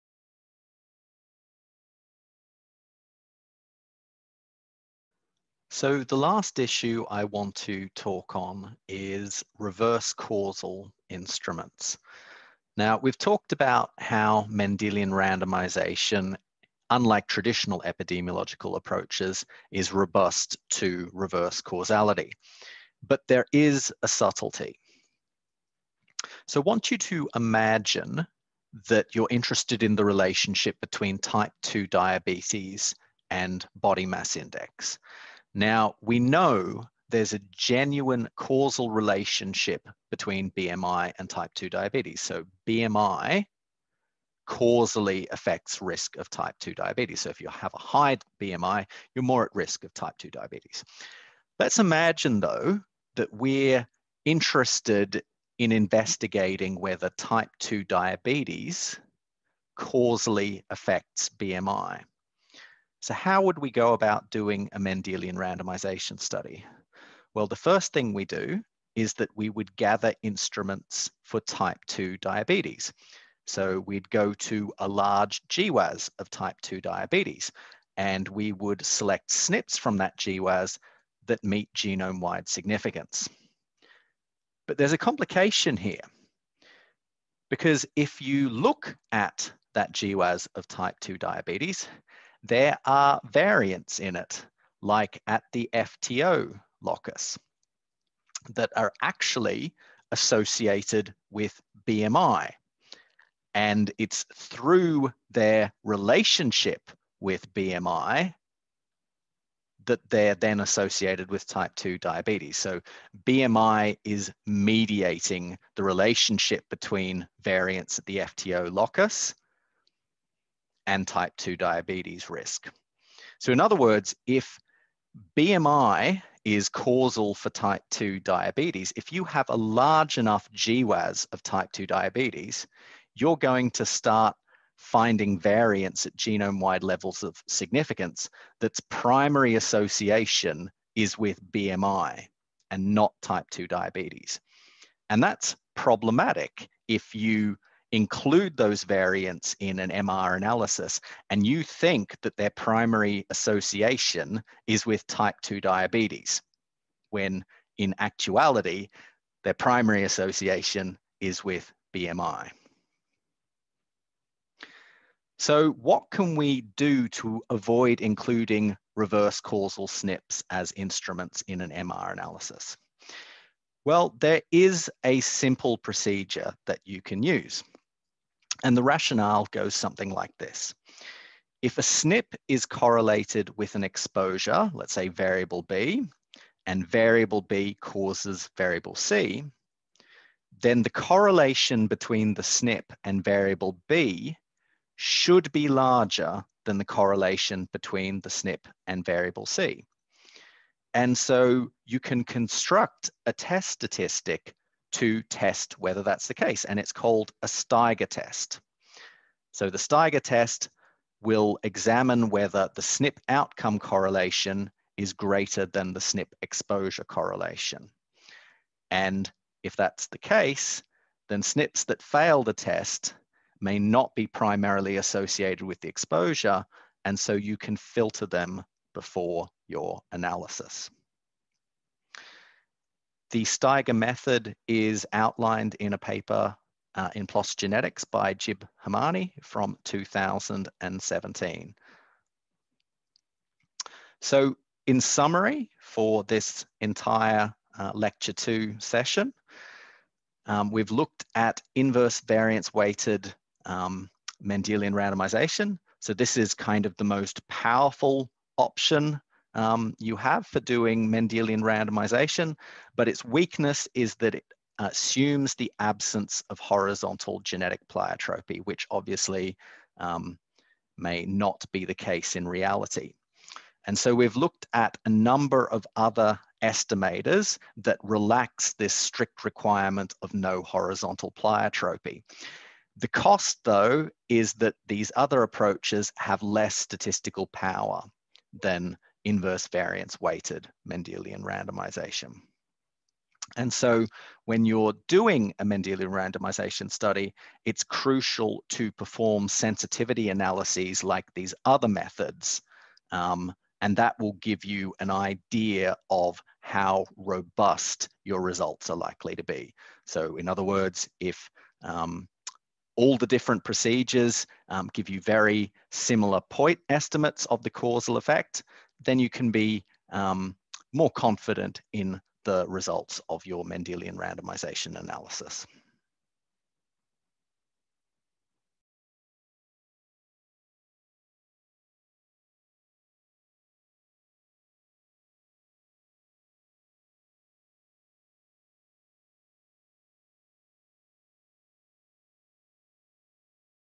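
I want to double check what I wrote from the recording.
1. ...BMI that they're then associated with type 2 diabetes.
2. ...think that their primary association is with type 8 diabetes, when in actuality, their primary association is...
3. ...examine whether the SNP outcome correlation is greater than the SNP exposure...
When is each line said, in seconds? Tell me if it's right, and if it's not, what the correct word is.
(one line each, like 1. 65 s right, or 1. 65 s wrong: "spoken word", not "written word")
1. 107 s right
2. 151 s wrong: "2", not "8"
3. 211 s right.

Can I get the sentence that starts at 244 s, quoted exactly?
So in summary, for this entire uh, lecture two session, um, we've looked at inverse variance weighted um, Mendelian randomization.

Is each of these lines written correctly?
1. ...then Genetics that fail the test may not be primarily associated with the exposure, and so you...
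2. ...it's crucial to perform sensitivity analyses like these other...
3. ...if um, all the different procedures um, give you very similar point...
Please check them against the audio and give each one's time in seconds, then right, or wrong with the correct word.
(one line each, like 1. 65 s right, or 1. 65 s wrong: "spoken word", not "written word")
1. 221 s wrong: "SNPs", not "Genetics"
2. 297 s right
3. 311 s right.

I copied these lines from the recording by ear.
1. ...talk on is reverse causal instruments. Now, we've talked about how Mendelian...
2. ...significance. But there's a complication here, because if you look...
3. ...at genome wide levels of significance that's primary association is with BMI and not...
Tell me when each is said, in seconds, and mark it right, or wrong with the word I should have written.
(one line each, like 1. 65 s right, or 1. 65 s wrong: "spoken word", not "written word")
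1. 7 s right
2. 82 s right
3. 136 s right.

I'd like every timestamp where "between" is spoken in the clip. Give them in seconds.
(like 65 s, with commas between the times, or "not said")
30 s, 40 s, 116 s, 191 s, 197 s.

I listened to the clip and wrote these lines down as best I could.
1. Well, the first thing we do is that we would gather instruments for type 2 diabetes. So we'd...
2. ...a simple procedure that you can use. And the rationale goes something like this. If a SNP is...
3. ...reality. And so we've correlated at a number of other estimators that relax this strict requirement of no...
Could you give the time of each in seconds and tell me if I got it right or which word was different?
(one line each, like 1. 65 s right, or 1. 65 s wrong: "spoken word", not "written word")
1. 67 s right
2. 175 s right
3. 272 s wrong: "looked", not "correlated".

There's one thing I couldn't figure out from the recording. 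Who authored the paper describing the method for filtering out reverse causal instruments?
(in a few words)
Gib Hemani.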